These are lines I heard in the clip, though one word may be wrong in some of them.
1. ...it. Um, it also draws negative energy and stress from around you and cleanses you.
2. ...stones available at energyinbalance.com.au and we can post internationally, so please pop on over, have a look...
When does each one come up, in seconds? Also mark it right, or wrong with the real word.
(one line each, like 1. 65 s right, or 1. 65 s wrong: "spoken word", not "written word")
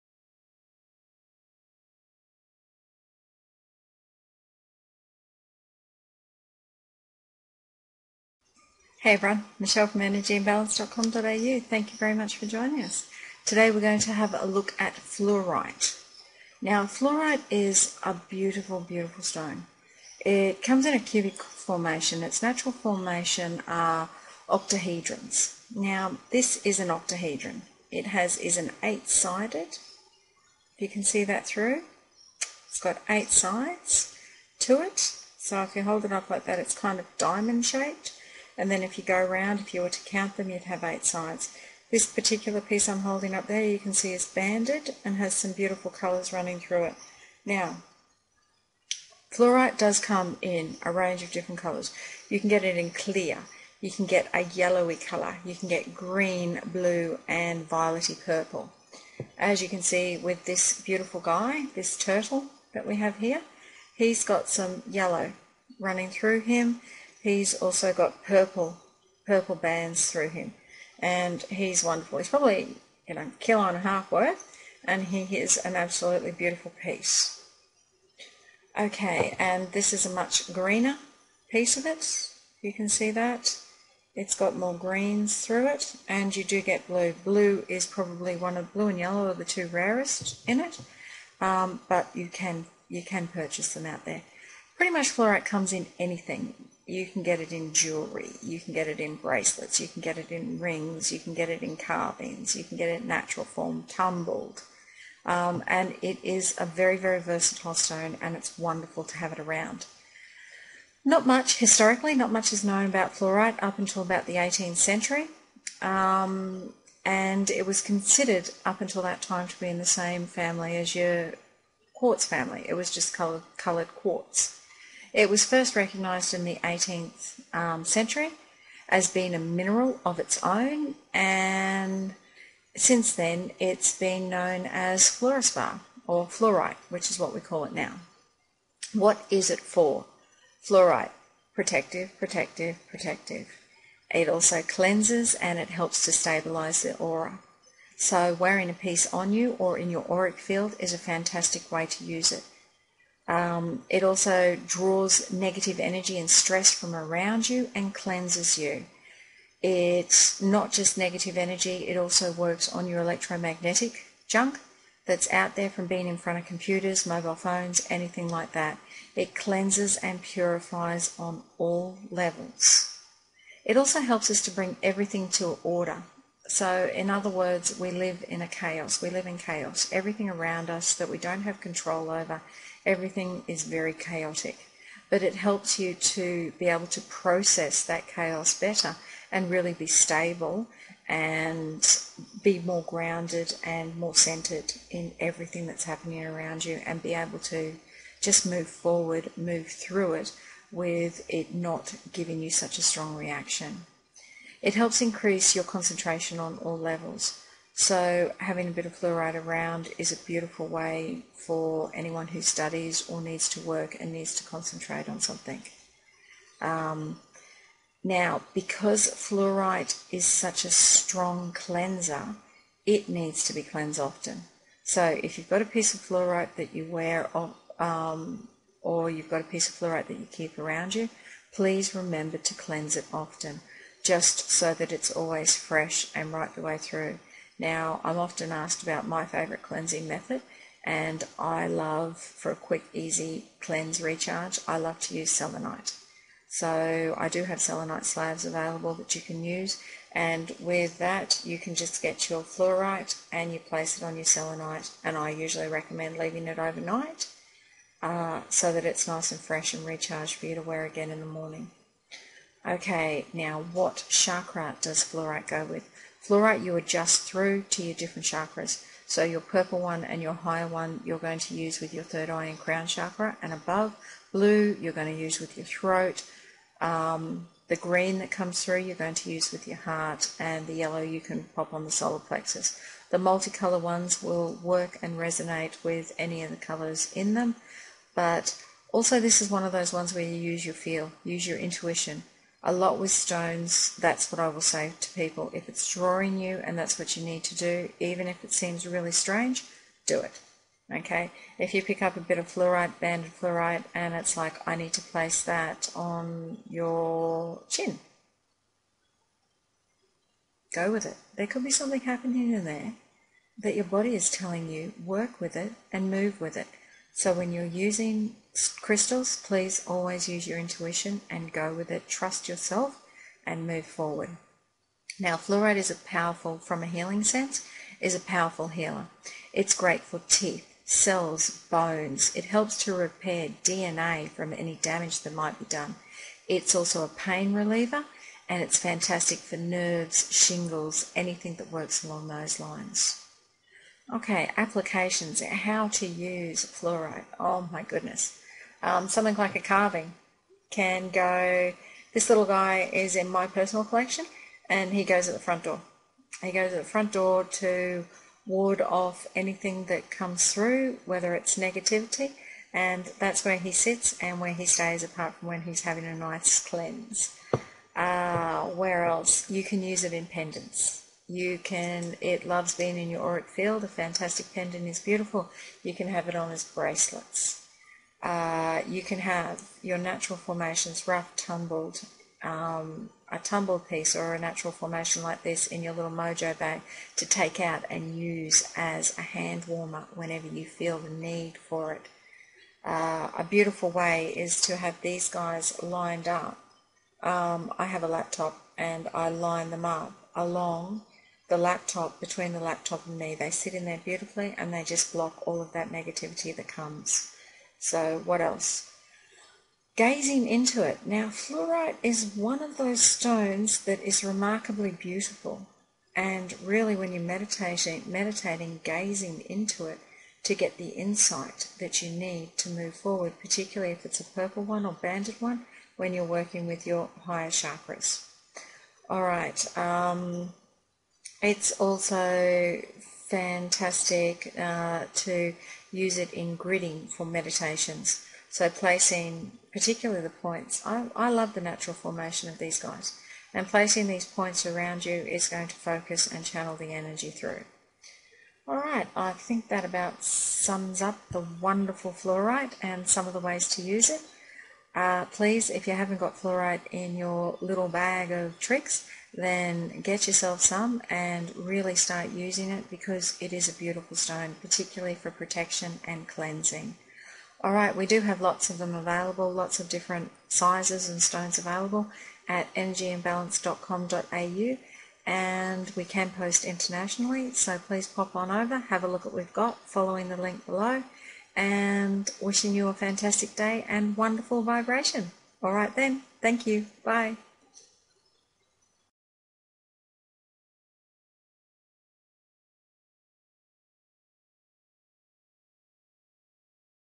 1. 152 s right
2. 471 s right.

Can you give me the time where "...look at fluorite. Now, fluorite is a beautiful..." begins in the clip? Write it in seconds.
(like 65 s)
14 s.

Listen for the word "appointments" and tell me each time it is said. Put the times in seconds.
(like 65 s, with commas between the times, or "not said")
not said.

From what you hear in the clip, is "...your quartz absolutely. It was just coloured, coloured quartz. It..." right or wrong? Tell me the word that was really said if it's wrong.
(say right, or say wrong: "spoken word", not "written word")
wrong: "family", not "absolutely".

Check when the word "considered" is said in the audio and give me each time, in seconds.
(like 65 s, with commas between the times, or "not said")
117 s.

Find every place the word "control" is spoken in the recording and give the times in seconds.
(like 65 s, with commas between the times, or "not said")
181 s.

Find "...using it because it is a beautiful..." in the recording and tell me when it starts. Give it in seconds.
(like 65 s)
462 s.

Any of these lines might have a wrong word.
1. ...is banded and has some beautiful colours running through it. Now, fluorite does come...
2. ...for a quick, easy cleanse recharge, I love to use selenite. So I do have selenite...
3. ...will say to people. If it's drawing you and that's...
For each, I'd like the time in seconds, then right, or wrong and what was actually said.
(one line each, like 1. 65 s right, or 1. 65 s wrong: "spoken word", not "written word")
1. 44 s right
2. 242 s right
3. 294 s right.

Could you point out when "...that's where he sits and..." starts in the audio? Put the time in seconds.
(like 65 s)
363 s.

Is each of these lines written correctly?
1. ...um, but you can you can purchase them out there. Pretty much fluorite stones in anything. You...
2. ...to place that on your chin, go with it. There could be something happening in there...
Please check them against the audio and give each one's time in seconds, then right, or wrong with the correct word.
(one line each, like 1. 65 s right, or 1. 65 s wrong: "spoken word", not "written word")
1. 91 s wrong: "comes", not "stones"
2. 304 s right.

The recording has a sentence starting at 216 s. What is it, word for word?
Um, now, because fluorite is such a strong cleanser, it needs to be cleansed often.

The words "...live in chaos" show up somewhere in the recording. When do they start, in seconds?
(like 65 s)
179 s.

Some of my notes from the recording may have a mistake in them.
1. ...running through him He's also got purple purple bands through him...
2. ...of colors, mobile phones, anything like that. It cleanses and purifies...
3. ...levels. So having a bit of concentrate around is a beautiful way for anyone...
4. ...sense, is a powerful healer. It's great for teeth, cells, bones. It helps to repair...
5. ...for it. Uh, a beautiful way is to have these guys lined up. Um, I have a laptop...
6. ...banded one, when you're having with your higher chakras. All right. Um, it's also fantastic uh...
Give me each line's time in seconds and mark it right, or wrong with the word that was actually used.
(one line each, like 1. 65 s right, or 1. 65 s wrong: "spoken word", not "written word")
1. 65 s right
2. 166 s wrong: "computers", not "colors"
3. 206 s wrong: "fluorite", not "concentrate"
4. 327 s right
5. 391 s right
6. 424 s wrong: "working", not "having".